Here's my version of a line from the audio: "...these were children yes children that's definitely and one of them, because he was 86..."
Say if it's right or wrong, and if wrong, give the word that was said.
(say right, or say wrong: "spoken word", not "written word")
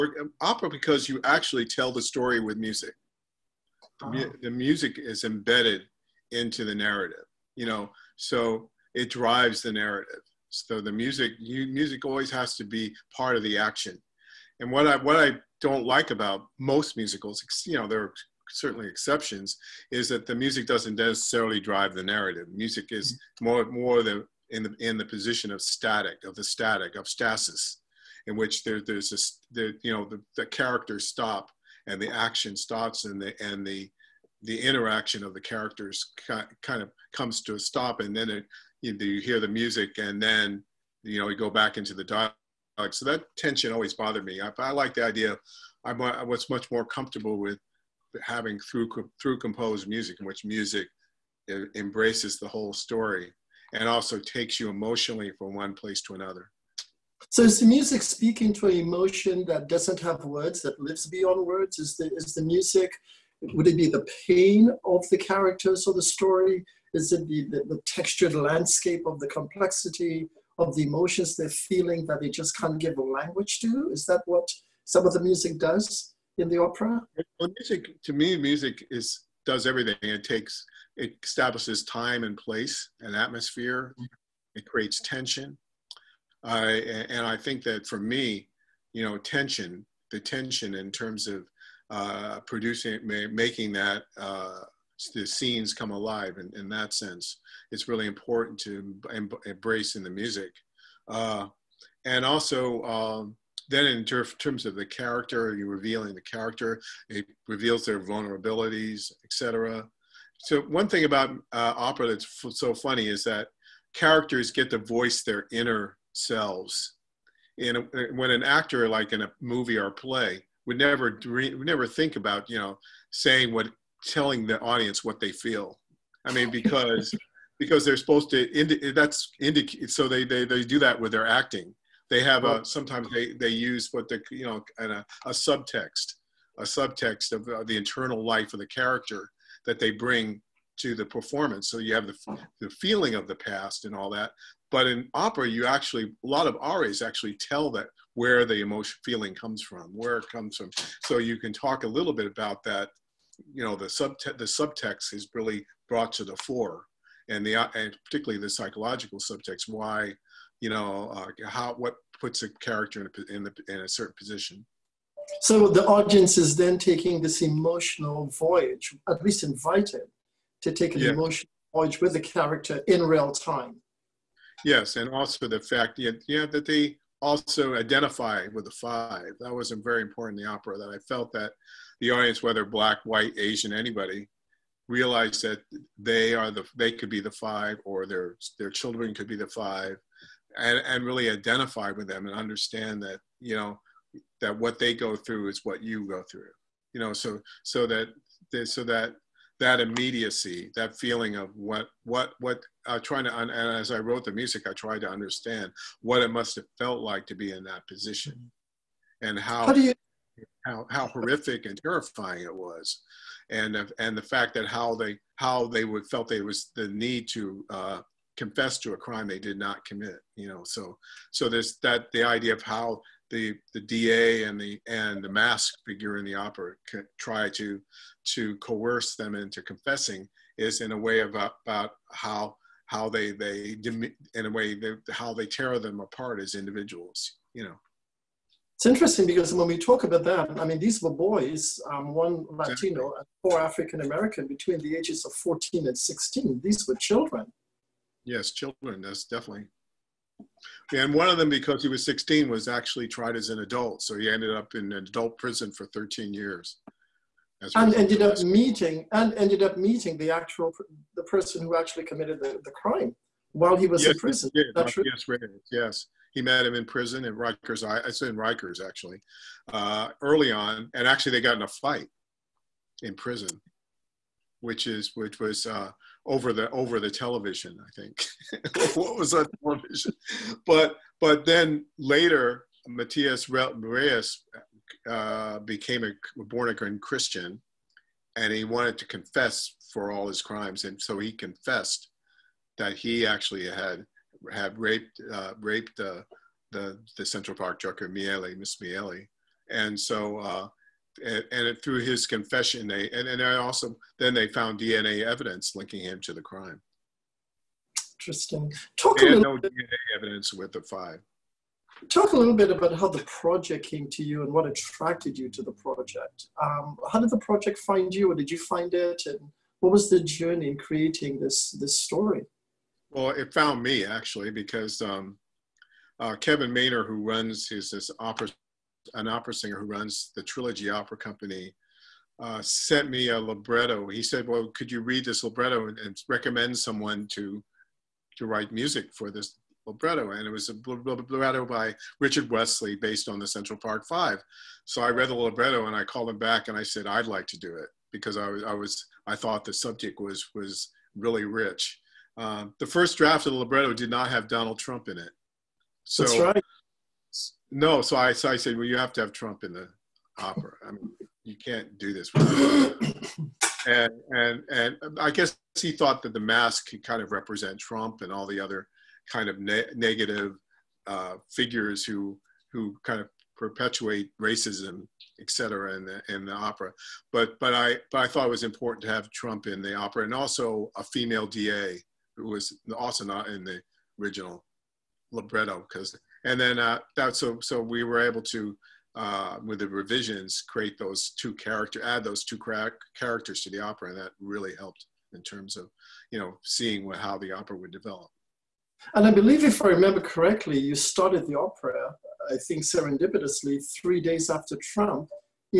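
wrong: "16", not "86".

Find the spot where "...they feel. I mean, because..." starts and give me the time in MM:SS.
02:05.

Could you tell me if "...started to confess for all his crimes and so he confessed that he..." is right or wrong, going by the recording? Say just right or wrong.
wrong.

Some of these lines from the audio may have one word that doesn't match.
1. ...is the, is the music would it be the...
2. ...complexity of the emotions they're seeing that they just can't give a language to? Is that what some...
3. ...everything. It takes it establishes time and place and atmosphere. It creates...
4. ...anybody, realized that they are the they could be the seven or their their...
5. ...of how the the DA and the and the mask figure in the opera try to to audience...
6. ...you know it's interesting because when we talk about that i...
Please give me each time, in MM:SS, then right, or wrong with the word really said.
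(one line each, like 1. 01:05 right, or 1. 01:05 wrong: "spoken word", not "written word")
1. 01:01 right
2. 01:09 wrong: "feeling", not "seeing"
3. 01:19 right
4. 03:03 wrong: "five", not "seven"
5. 03:42 wrong: "coerce", not "audience"
6. 03:57 right.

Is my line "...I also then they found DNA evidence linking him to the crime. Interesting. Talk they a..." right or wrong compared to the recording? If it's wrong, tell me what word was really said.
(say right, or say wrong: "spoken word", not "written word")
right.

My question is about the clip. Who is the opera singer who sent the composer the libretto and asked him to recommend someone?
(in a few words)
Kevin Maynor.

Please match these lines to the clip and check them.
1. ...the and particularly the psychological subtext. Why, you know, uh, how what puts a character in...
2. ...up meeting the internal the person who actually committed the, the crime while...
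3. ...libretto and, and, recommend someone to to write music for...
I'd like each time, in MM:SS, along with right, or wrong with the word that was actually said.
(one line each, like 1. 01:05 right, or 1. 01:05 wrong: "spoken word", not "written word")
1. 02:37 right
2. 04:19 wrong: "actual", not "internal"
3. 05:35 right.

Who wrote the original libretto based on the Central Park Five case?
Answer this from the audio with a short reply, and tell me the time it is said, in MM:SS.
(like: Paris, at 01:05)
Richard Wesley, at 05:42.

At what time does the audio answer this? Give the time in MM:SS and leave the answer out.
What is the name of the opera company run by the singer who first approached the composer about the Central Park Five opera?
05:30.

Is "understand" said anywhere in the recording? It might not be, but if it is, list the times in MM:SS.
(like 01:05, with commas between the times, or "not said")
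03:12, 03:25.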